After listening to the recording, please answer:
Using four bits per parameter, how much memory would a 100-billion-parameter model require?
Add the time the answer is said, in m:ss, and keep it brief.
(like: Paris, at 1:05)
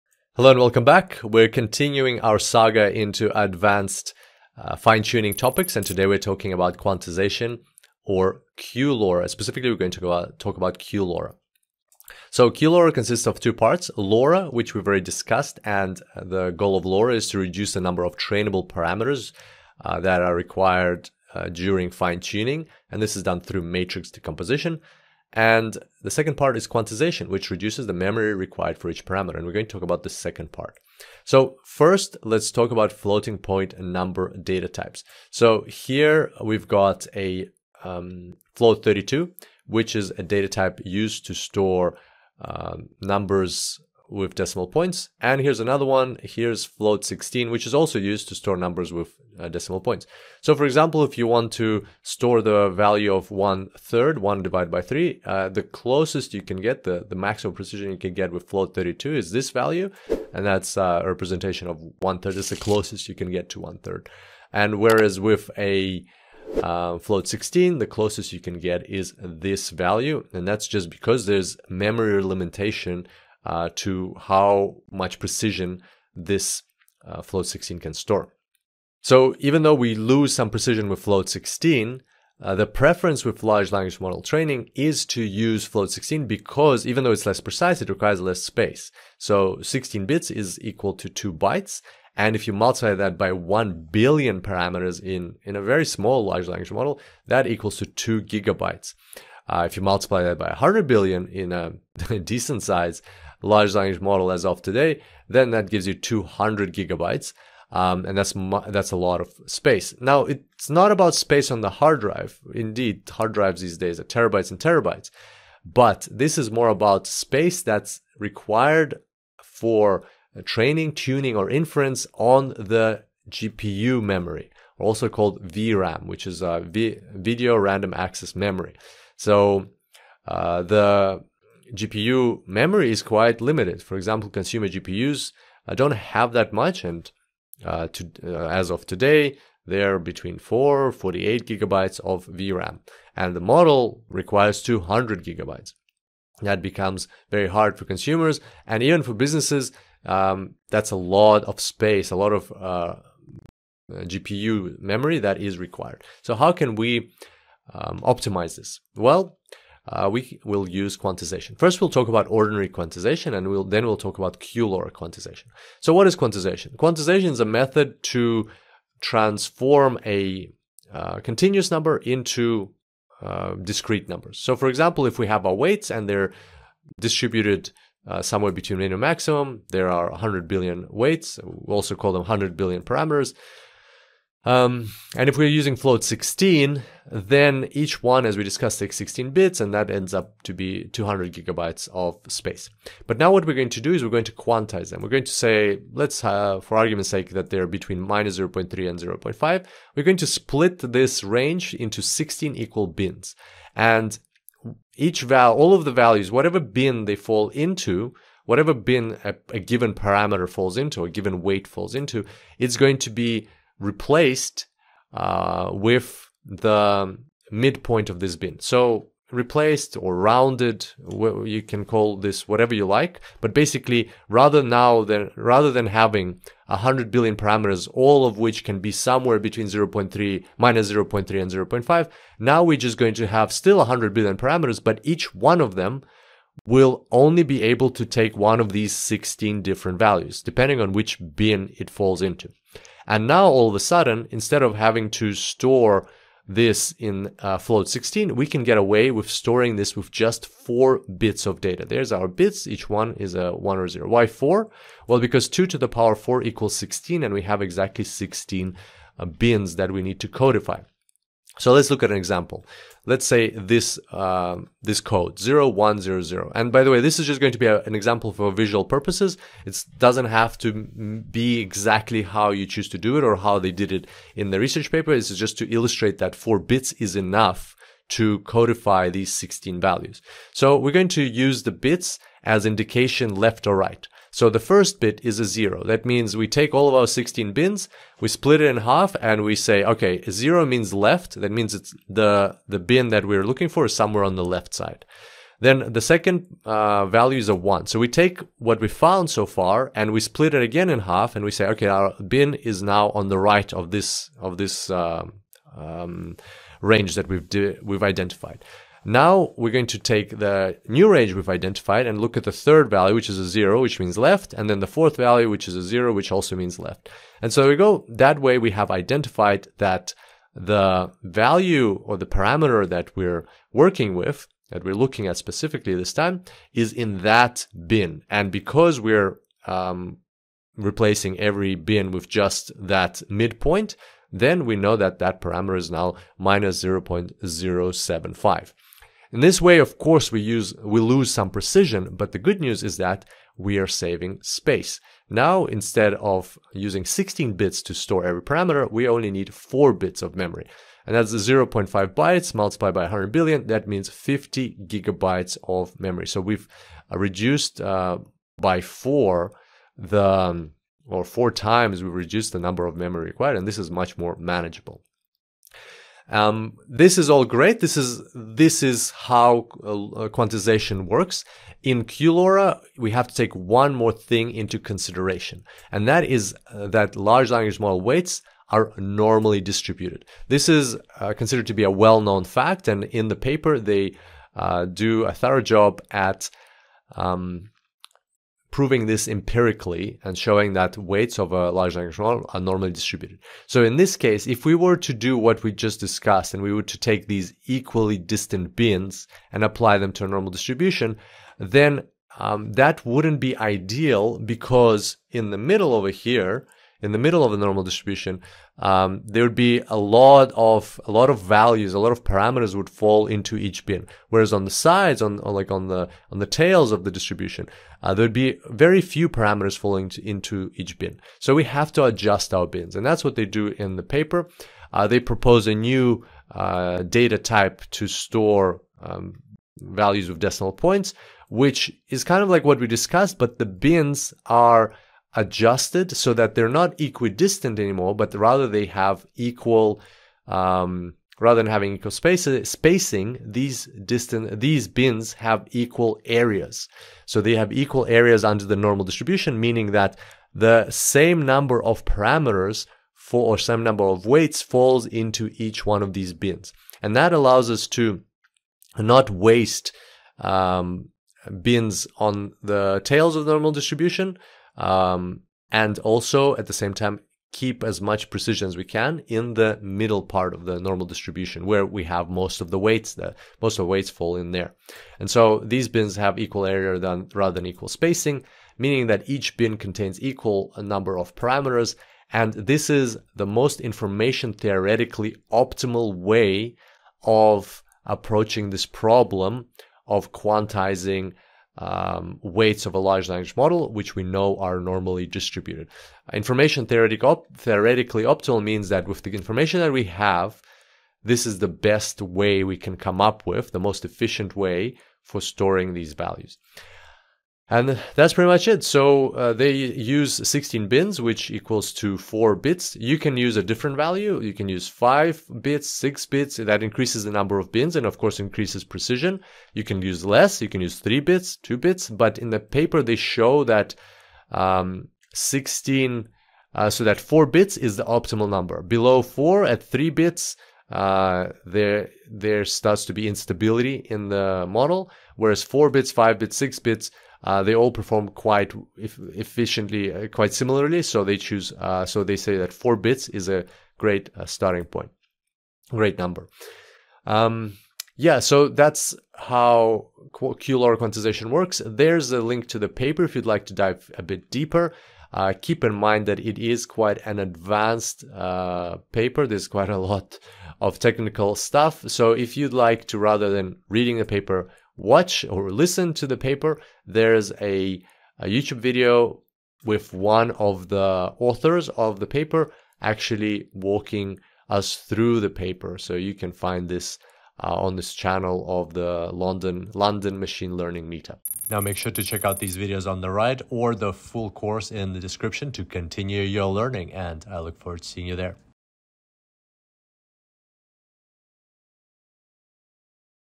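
50 gigabytes, at 5:54.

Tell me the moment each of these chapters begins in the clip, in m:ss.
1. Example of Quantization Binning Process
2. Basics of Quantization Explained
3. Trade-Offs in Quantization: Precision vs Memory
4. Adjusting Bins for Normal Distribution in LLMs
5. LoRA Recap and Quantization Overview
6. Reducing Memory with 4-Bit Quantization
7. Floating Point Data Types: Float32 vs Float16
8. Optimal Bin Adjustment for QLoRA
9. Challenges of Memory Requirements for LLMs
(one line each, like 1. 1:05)
1. 4:17
2. 2:28
3. 5:23
4. 5:54
5. 0:30
6. 3:04
7. 1:08
8. 6:34
9. 1:44.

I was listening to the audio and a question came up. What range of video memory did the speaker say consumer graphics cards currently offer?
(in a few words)
4 to 48 gigabytes.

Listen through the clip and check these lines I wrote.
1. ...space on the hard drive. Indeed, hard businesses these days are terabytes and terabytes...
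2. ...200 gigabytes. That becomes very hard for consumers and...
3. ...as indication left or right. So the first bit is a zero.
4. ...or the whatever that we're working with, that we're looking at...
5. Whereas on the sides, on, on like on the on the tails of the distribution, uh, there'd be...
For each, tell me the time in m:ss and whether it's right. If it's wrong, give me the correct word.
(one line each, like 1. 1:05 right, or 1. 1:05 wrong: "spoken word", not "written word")
1. 1:51 wrong: "drives", not "businesses"
2. 2:24 right
3. 4:42 right
4. 5:22 wrong: "parameter", not "whatever"
5. 6:54 right.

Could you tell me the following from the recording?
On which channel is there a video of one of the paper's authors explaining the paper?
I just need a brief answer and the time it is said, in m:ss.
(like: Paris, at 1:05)
London Machine Learning Meetup, at 9:39.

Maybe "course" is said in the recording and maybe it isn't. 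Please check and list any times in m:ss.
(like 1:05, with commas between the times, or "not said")
5:39, 8:38, 9:44.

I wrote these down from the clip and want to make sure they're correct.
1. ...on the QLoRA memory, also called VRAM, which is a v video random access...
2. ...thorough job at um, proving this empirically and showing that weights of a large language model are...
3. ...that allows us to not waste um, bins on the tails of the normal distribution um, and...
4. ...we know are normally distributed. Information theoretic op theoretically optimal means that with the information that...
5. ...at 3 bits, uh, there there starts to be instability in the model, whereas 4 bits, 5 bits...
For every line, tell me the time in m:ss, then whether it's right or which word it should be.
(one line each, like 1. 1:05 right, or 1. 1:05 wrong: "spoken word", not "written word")
1. 2:02 wrong: "GPU", not "QLoRA"
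2. 6:25 right
3. 7:37 right
4. 8:14 right
5. 8:49 right.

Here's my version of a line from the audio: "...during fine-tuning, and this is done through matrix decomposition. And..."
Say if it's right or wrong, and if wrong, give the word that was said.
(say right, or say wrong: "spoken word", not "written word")
right.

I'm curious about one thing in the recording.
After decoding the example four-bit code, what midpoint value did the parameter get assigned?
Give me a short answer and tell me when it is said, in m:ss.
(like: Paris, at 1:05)
-0.075, at 5:36.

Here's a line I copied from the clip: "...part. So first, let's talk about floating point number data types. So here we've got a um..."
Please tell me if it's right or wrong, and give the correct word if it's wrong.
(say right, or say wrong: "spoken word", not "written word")
right.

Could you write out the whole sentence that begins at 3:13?
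But now what we're going to do is we're going to quantize them.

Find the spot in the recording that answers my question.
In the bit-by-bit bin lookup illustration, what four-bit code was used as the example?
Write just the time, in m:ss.
4:25.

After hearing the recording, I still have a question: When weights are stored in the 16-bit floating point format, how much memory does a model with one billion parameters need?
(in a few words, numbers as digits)
2 gigabytes.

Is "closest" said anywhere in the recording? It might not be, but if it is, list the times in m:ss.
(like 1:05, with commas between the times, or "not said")
0:55, 1:02, 1:07.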